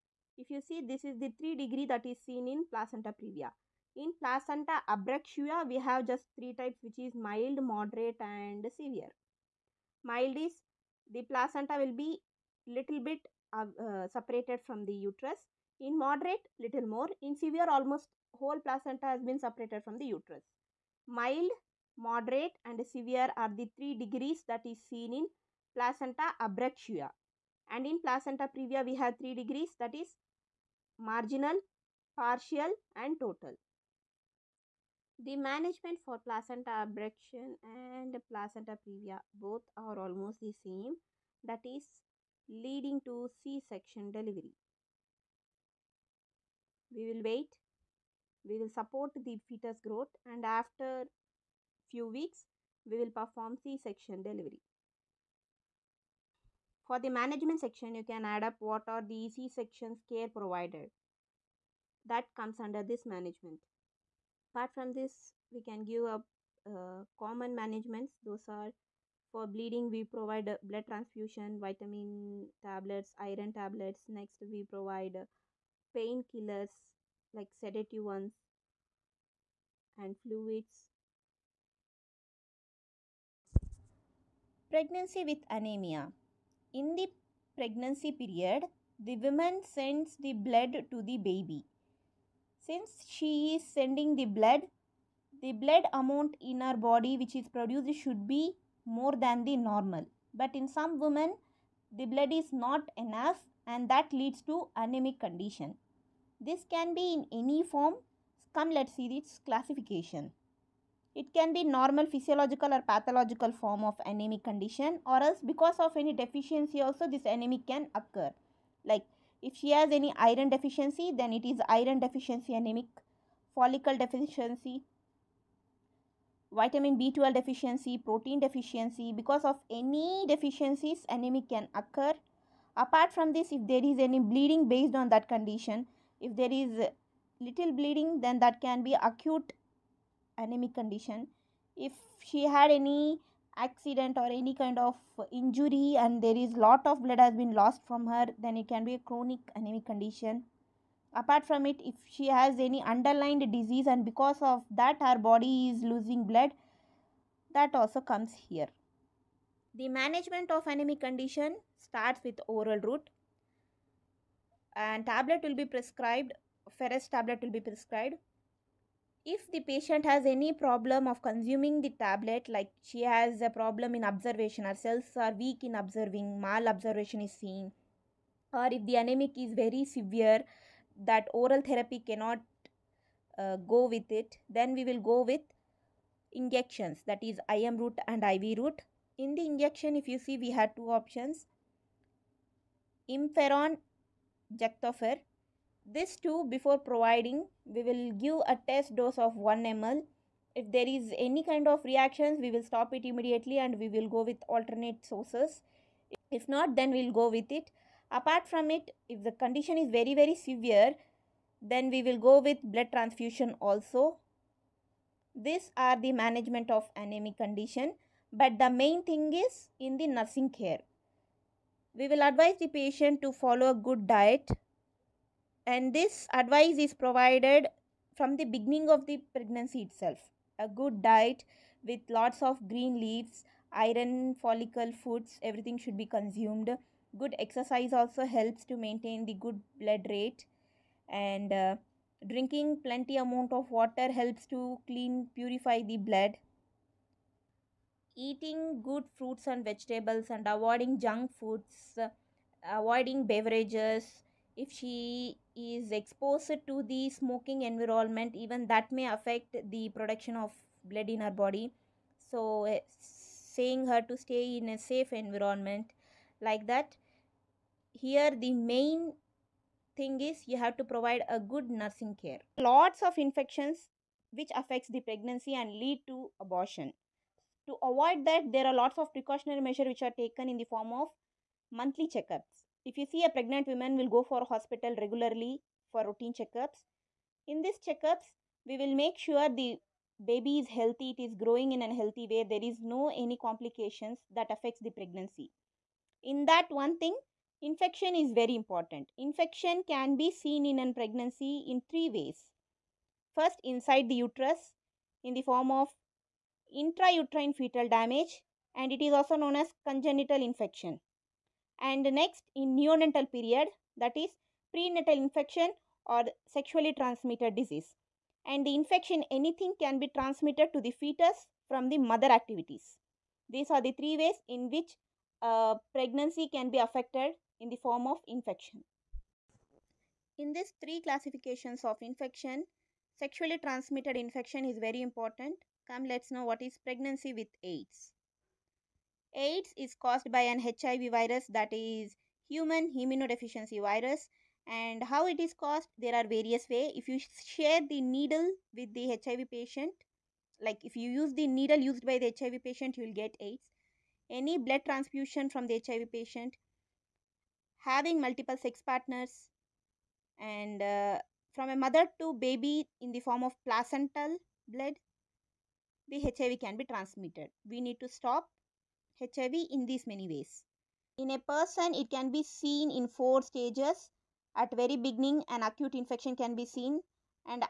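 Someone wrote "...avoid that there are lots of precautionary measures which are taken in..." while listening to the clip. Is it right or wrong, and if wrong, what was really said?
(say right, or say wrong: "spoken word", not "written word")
right.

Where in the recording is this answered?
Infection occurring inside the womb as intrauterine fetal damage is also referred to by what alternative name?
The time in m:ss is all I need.
5:09.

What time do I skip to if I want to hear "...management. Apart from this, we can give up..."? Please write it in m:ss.
1:03.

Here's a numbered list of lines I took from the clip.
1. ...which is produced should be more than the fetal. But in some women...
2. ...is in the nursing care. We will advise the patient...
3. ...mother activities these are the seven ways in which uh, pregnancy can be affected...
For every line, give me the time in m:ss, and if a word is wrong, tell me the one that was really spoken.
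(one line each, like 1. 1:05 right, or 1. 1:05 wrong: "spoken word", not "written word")
1. 1:37 wrong: "normal", not "fetal"
2. 3:39 right
3. 5:22 wrong: "three", not "seven".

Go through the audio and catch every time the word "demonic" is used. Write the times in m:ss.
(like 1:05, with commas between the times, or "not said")
not said.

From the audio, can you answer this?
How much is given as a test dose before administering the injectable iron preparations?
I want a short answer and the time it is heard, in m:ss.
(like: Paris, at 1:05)
1 ml, at 3:19.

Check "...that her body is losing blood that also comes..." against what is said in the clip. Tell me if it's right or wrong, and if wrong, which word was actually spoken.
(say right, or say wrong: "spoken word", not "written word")
right.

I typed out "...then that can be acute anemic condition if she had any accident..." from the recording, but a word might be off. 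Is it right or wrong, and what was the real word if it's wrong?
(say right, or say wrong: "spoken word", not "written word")
right.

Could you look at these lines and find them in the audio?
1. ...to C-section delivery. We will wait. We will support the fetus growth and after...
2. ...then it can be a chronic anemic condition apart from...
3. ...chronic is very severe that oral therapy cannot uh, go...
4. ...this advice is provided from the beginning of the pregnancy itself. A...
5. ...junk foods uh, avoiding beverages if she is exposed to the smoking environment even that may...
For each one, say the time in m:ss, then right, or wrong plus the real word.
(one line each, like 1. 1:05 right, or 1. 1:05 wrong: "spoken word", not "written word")
1. 0:43 right
2. 2:28 right
3. 2:58 wrong: "anemic", not "chronic"
4. 3:45 right
5. 4:11 right.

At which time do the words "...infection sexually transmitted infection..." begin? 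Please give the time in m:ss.
5:32.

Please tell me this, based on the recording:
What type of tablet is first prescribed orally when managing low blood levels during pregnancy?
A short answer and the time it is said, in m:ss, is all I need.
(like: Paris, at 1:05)
Ferrous tablet, at 2:46.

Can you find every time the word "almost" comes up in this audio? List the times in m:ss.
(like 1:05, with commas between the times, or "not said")
0:17, 0:39.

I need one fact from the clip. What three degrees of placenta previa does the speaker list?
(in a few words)
Marginal, partial and total.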